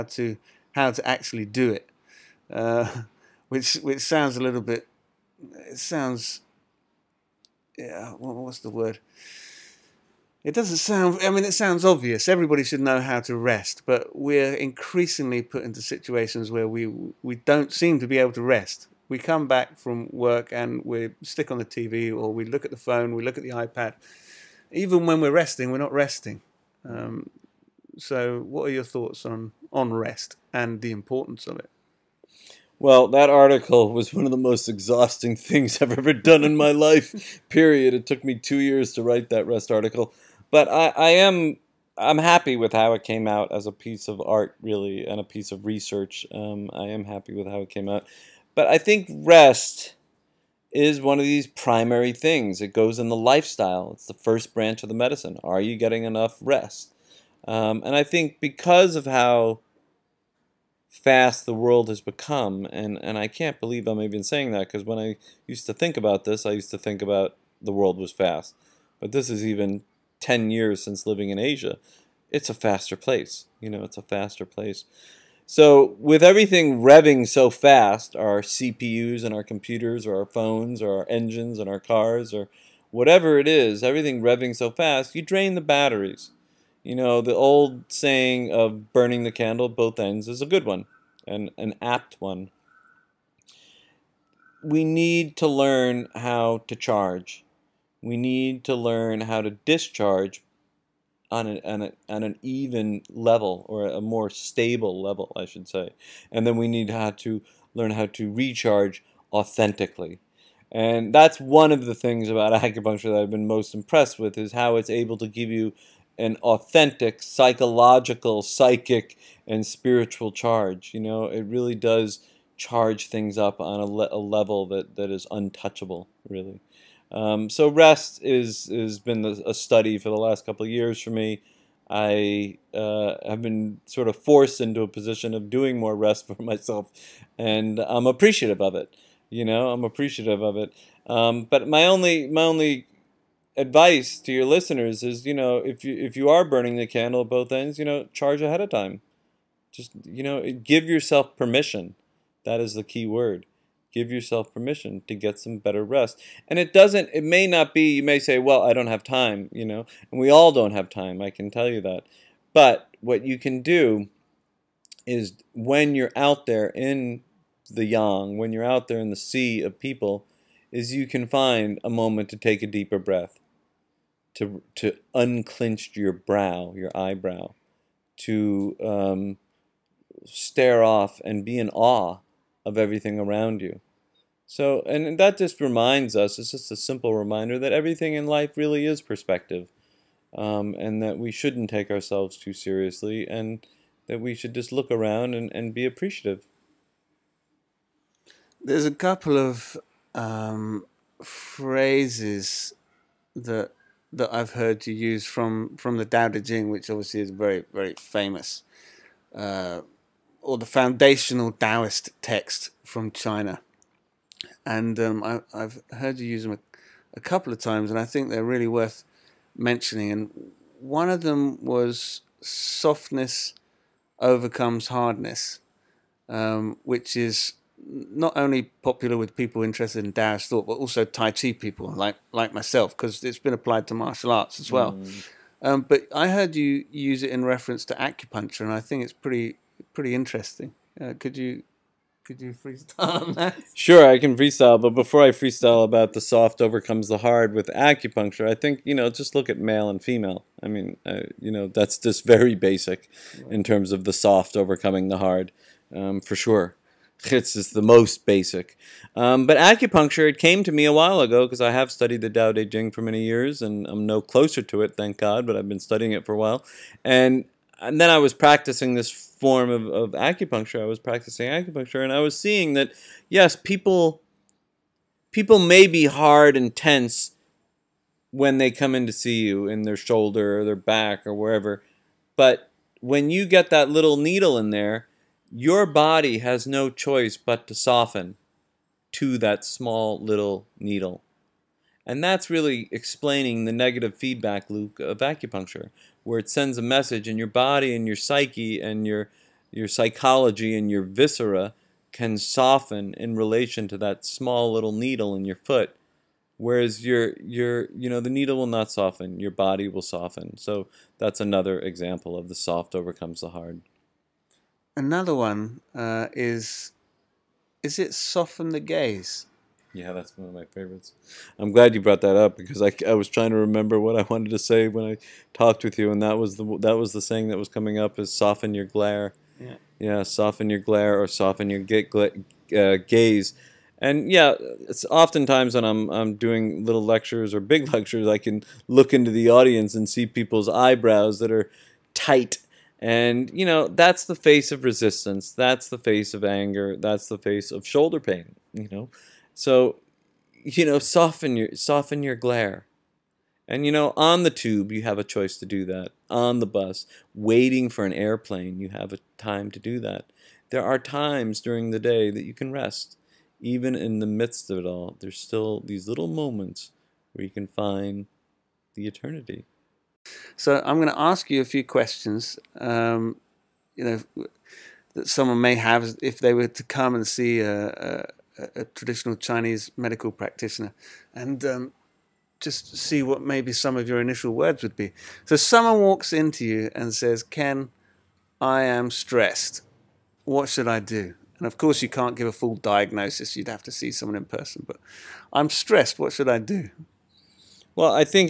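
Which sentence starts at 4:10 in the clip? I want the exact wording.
I mean, uh, you know, that's just very basic right.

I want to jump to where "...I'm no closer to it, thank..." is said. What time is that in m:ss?
4:23.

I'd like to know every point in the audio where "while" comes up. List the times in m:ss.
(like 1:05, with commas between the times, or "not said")
4:20, 4:26.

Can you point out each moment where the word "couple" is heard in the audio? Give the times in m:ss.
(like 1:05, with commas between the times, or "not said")
2:10, 3:18, 3:37.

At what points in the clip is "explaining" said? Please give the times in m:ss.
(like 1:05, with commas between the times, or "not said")
4:52.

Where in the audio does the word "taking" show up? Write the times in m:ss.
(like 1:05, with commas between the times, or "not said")
not said.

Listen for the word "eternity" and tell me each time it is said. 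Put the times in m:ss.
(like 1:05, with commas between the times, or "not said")
6:09.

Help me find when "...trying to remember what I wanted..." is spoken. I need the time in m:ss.
5:23.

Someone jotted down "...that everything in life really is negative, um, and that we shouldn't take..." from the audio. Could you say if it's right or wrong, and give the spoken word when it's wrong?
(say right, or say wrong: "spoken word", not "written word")
wrong: "perspective", not "negative".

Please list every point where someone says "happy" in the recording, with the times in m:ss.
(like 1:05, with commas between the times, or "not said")
0:42, 0:47.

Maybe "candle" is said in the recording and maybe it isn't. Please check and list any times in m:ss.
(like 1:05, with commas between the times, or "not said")
1:29, 2:26.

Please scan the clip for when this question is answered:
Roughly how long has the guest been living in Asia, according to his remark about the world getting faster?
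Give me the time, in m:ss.
1:10.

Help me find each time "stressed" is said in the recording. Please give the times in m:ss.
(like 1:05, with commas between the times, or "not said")
6:29, 6:35.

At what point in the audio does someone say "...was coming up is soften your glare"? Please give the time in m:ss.
5:27.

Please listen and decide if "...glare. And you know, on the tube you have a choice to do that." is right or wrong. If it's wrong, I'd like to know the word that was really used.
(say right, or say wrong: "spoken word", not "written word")
right.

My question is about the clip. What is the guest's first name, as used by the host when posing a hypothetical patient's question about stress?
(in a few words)
Ken.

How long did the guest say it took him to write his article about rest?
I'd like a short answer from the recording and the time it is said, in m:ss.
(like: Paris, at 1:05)
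2 years, at 0:38.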